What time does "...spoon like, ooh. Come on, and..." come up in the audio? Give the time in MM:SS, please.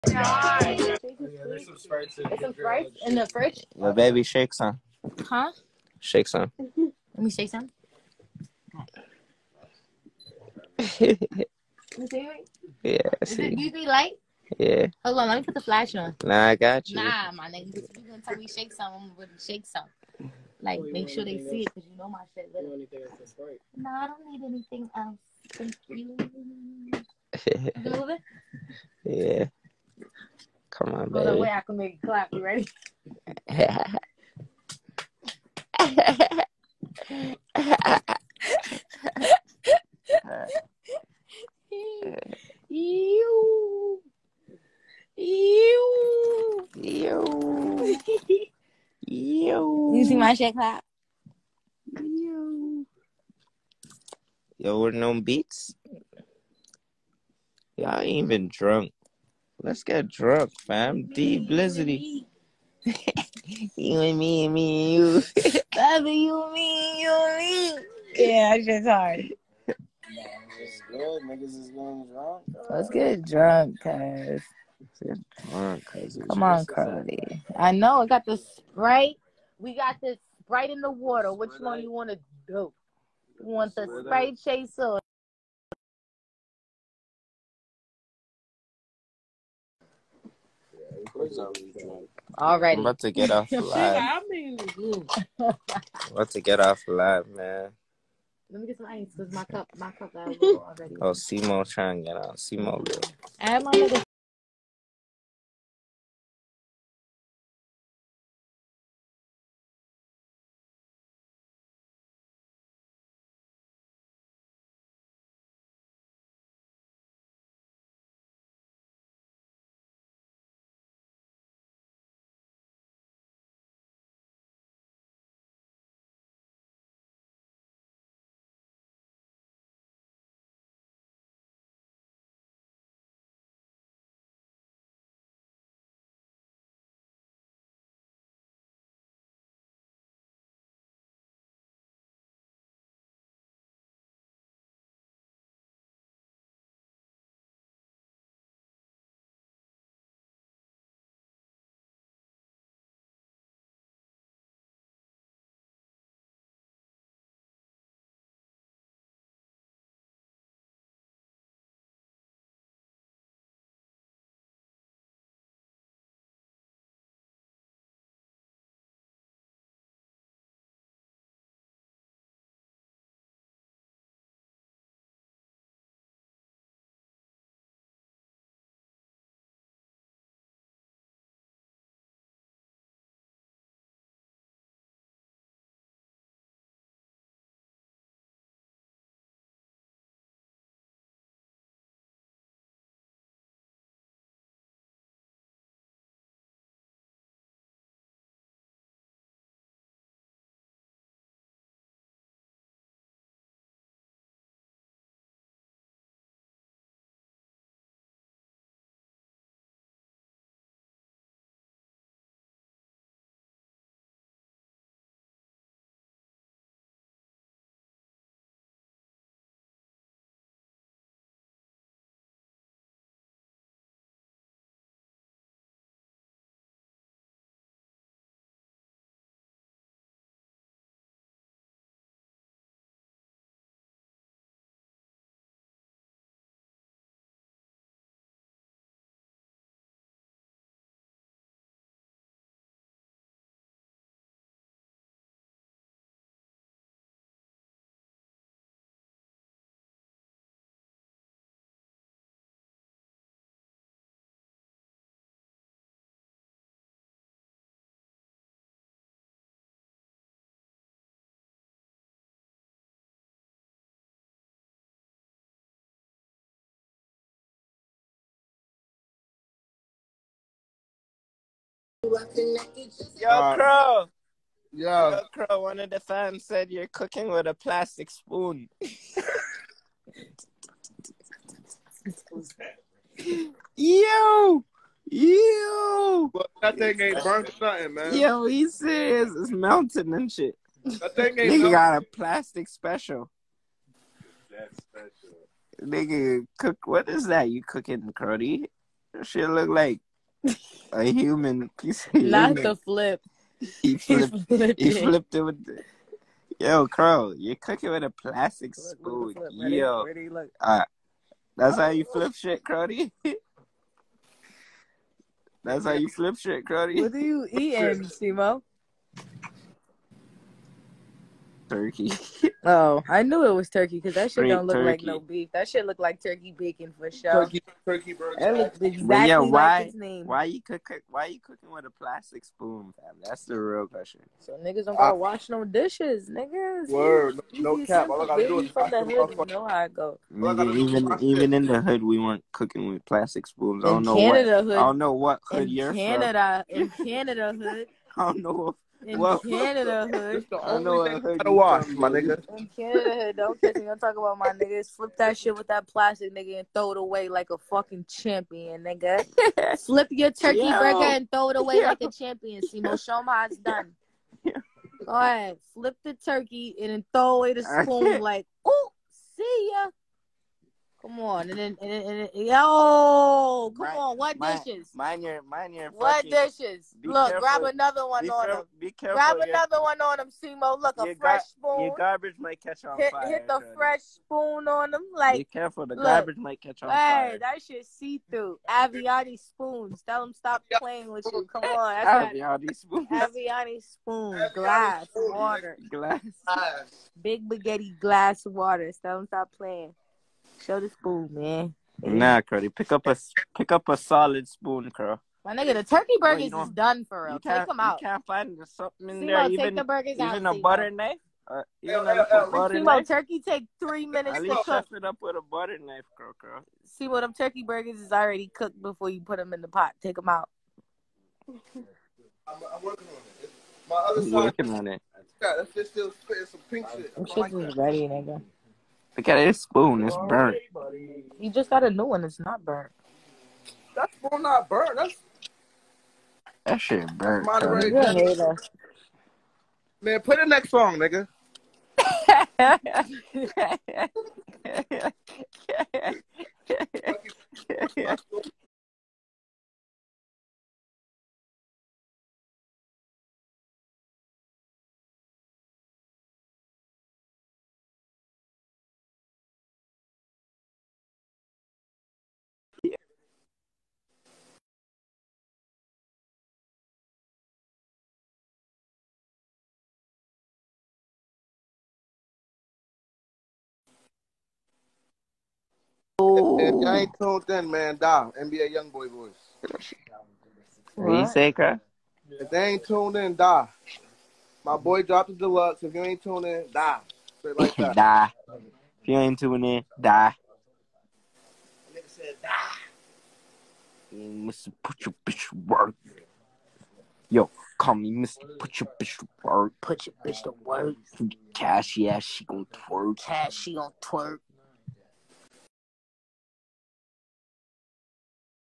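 06:07.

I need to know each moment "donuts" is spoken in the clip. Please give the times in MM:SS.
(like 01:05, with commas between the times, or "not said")
not said.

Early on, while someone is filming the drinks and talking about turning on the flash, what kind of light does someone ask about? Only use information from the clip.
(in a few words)
UV light.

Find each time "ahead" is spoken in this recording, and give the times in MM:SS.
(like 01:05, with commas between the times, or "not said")
06:05.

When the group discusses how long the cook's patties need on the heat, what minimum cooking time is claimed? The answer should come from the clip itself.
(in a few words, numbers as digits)
3 minutes.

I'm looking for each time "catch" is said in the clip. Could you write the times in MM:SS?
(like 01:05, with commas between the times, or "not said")
05:53, 06:22, 06:26.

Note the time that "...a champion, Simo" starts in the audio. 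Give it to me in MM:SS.
06:02.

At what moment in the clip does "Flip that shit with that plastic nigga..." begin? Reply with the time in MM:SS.
05:54.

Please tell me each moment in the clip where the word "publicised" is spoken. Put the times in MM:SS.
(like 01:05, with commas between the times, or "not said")
not said.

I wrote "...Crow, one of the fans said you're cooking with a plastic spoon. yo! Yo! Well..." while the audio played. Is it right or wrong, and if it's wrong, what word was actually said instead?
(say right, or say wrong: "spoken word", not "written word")
right.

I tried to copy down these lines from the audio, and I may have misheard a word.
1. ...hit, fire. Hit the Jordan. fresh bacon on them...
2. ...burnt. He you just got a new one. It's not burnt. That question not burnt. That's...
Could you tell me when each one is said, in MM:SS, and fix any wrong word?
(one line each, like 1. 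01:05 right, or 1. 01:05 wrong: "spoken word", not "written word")
1. 06:22 wrong: "spoon", not "bacon"
2. 07:10 wrong: "spoon", not "question".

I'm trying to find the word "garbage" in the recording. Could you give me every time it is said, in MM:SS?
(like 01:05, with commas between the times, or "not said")
06:21, 06:26.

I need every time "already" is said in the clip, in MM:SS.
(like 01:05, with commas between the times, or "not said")
01:40, 06:58.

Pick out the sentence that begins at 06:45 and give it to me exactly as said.
My nigga, the turkey burgers is done for real.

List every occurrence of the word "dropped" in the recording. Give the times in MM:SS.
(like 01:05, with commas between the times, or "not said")
08:05.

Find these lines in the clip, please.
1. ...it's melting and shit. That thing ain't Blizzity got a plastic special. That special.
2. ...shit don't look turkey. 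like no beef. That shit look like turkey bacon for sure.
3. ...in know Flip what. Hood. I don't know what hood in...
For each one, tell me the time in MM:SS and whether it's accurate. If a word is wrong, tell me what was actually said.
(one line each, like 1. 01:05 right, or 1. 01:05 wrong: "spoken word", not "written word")
1. 04:49 wrong: "Nigga", not "Blizzity"
2. 05:24 right
3. 05:43 wrong: "Canada", not "Flip".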